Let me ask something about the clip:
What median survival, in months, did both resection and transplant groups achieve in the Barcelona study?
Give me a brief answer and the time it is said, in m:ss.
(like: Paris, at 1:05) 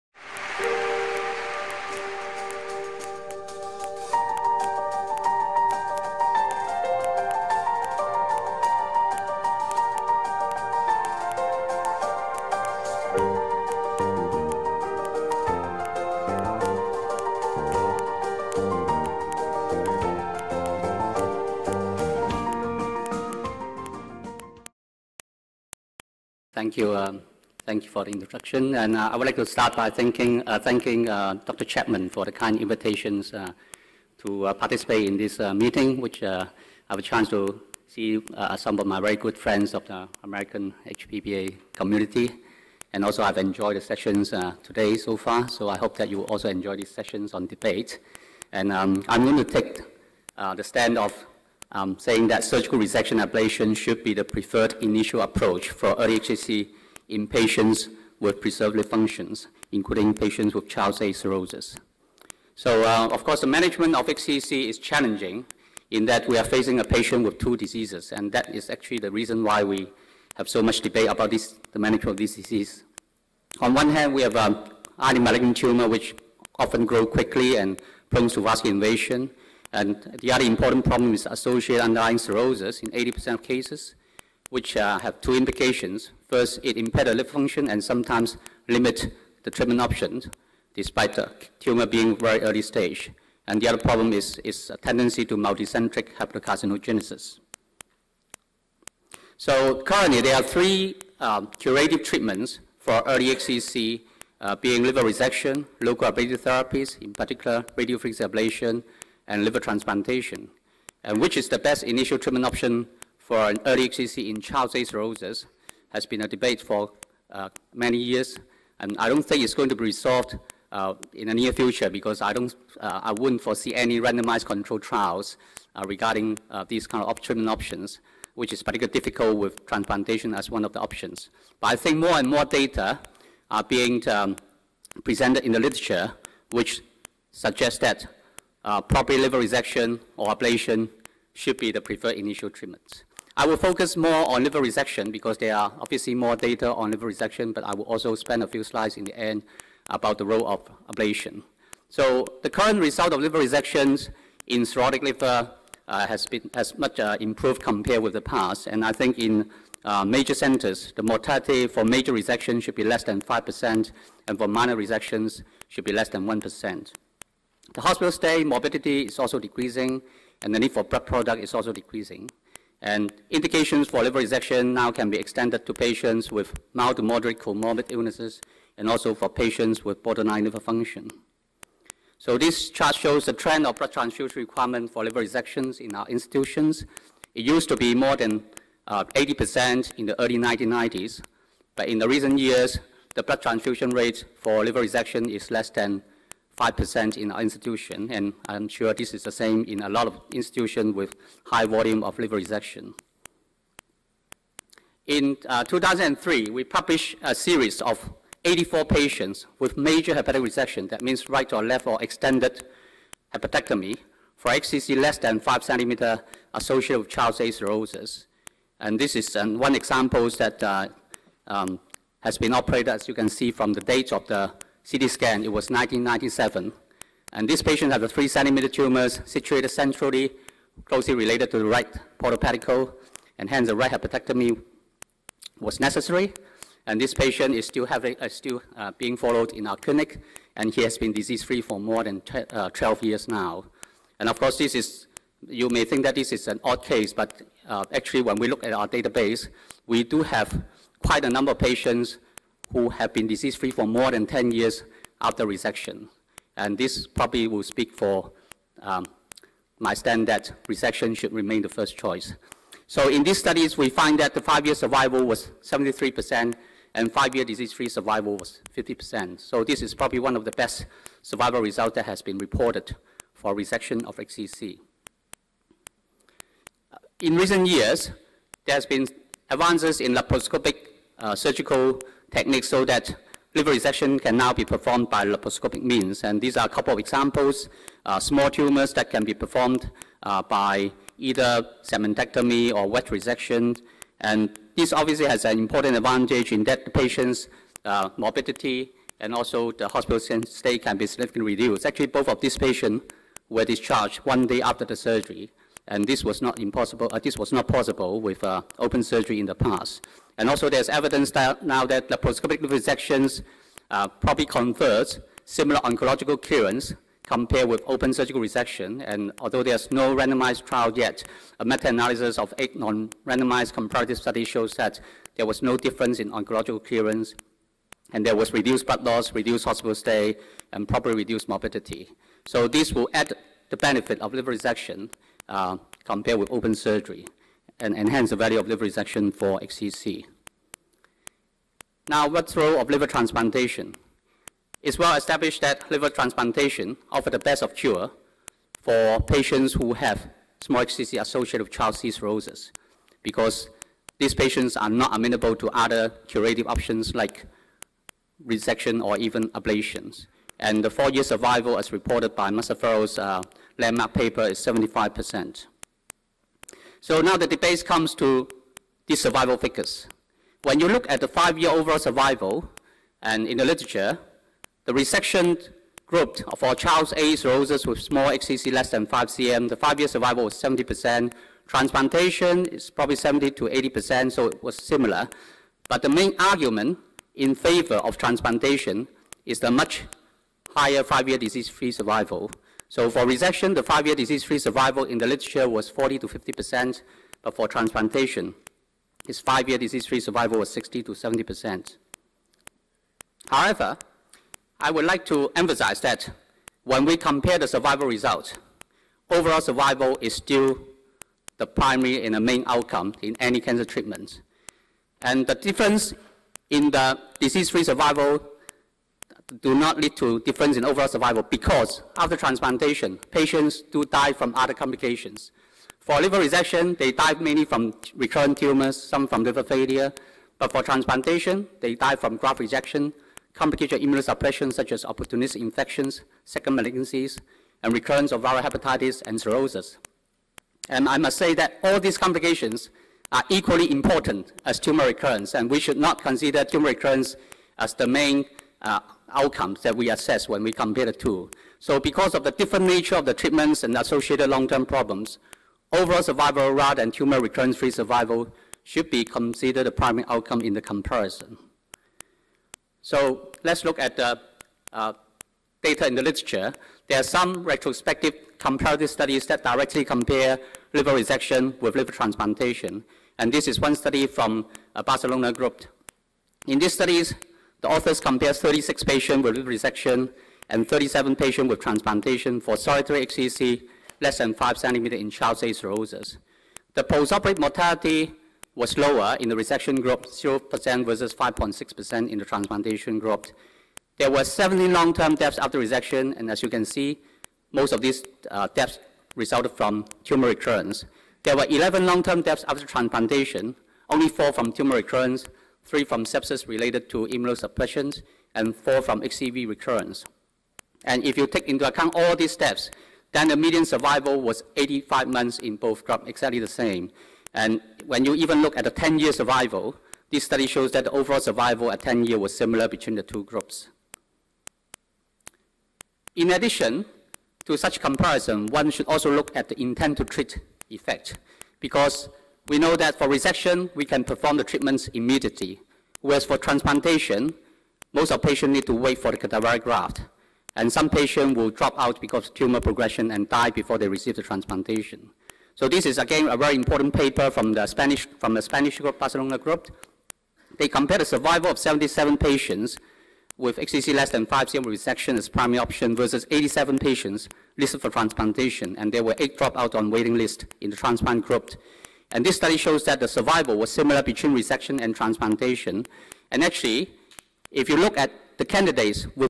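85 months, at 8:34.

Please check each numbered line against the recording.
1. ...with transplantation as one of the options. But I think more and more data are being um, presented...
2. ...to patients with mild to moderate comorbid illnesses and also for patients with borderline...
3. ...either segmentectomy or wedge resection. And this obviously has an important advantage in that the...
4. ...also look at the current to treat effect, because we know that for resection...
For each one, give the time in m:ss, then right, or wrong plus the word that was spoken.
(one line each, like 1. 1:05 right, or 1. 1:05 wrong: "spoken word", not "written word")
1. 2:09 right
2. 2:55 right
3. 4:51 right
4. 8:49 wrong: "intent", not "current".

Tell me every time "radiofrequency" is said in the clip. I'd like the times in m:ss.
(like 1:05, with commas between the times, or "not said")
1:47.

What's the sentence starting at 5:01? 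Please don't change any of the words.
Actually, both of these patients were discharged one day after the surgery and this was not impossible.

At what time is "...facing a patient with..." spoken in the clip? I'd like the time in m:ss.
1:06.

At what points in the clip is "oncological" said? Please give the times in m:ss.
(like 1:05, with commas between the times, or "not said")
5:15, 5:26.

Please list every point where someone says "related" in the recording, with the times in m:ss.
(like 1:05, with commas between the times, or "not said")
3:51, 8:26.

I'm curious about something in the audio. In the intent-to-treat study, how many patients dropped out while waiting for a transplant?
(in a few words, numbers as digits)
8.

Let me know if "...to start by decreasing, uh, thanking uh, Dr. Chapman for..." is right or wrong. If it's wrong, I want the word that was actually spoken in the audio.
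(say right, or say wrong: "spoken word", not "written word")
wrong: "thanking", not "decreasing".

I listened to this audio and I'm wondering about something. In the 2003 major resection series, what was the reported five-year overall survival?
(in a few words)
73%.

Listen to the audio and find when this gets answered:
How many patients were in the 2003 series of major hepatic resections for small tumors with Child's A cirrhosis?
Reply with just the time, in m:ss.
3:28.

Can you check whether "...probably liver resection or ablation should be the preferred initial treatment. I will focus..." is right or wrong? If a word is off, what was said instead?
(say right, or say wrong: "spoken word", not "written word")
right.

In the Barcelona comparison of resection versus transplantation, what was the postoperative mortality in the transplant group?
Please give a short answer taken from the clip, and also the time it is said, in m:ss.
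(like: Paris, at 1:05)
5.6%, at 8:11.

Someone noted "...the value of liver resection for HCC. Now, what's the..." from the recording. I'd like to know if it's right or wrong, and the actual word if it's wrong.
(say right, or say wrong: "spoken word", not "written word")
right.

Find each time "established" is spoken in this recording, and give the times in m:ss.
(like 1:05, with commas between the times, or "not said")
5:45.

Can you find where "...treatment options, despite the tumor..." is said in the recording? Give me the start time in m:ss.
1:29.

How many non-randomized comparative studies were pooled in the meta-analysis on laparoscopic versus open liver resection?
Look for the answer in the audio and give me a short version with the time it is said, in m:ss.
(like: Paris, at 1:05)
8, at 5:22.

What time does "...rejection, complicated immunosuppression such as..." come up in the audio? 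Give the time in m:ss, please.
7:12.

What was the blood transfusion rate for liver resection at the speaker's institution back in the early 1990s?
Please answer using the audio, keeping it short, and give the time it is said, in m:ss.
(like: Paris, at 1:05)
More than 80%, at 3:07.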